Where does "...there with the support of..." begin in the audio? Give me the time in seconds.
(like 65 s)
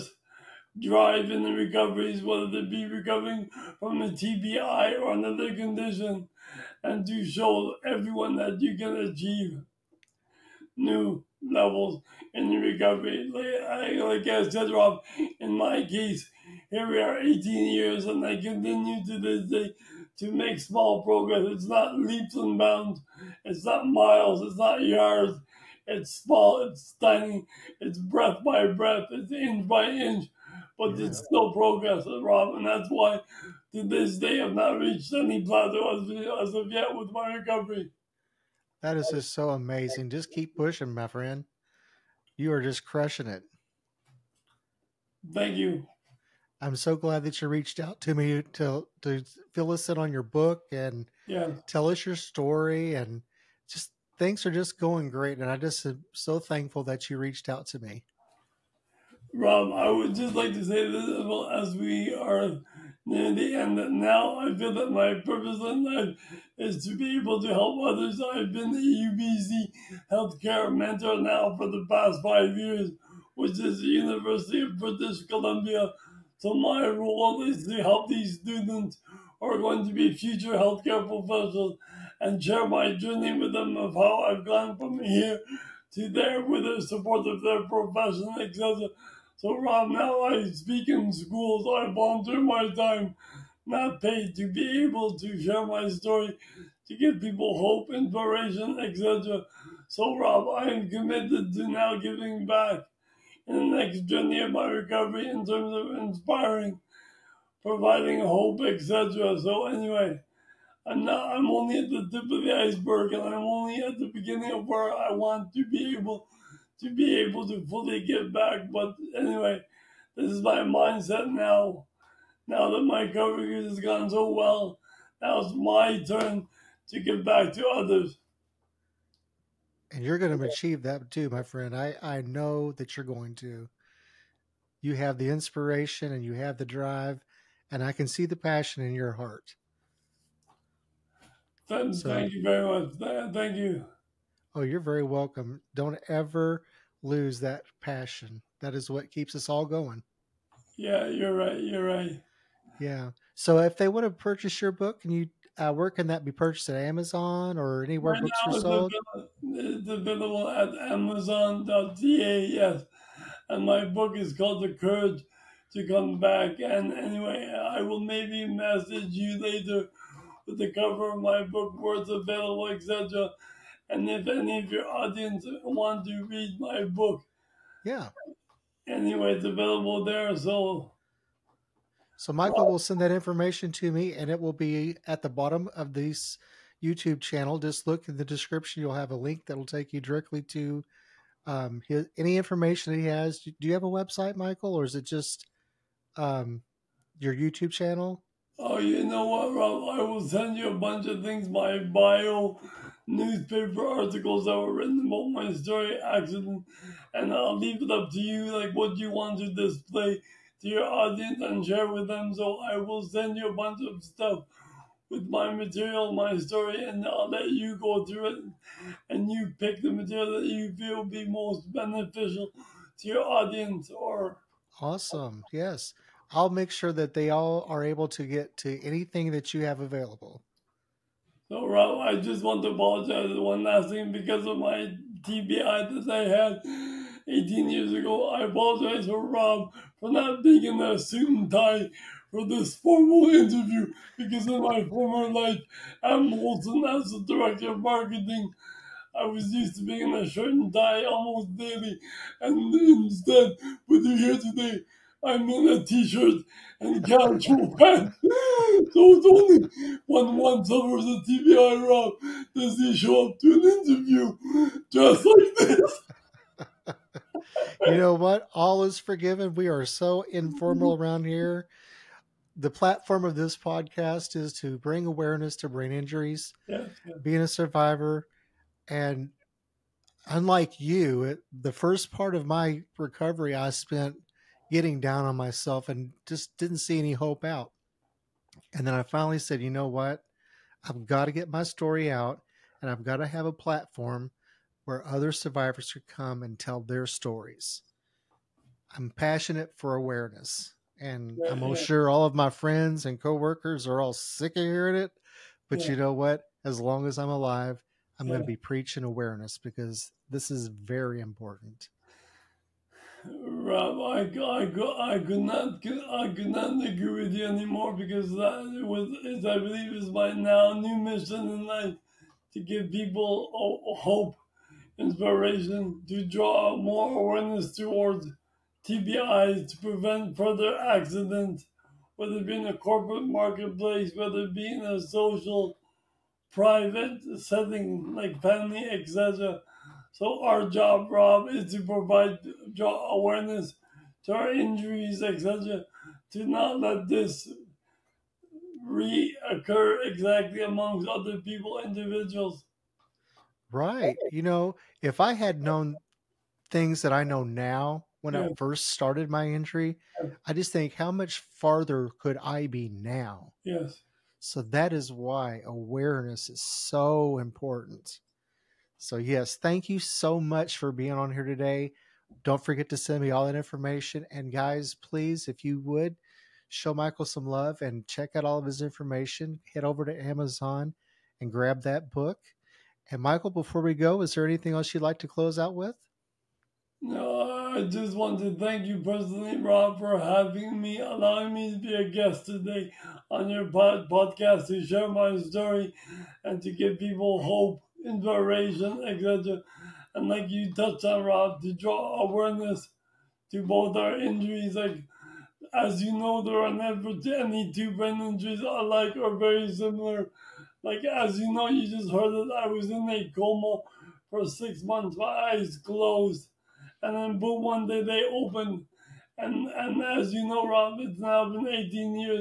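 86 s.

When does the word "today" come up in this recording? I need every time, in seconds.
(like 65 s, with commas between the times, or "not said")
254 s, 371 s, 392 s.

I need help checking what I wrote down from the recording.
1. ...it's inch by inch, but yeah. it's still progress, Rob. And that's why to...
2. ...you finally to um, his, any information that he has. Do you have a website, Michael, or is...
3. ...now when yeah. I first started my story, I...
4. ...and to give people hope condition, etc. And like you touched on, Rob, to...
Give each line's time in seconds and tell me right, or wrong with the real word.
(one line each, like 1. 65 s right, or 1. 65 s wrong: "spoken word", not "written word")
1. 29 s right
2. 189 s wrong: "directly", not "finally"
3. 357 s wrong: "injury", not "story"
4. 396 s wrong: "inspiration", not "condition".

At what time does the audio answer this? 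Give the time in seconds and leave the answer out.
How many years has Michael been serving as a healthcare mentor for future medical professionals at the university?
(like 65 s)
72 s.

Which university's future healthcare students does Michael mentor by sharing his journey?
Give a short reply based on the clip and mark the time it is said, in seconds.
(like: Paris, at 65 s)
University of British Columbia, at 73 s.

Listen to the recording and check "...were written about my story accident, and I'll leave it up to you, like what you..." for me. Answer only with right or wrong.
right.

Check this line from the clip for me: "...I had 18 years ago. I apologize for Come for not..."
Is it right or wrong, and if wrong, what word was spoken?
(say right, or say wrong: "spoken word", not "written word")
wrong: "Rob", not "Come".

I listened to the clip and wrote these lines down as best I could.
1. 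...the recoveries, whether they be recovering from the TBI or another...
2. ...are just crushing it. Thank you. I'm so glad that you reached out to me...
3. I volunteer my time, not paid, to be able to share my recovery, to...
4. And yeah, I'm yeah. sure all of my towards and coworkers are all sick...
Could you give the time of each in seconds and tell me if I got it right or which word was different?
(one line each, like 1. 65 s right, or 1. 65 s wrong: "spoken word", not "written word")
1. 1 s right
2. 42 s right
3. 91 s wrong: "story", not "recovery"
4. 300 s wrong: "friends", not "towards".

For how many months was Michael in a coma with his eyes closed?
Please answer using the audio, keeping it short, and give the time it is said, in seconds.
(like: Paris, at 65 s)
6, at 414 s.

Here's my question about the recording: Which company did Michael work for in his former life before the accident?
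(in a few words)
Molson.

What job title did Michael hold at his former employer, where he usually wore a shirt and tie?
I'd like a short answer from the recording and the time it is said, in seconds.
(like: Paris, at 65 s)
Director of marketing, at 247 s.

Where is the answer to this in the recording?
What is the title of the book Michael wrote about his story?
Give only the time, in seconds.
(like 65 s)
164 s.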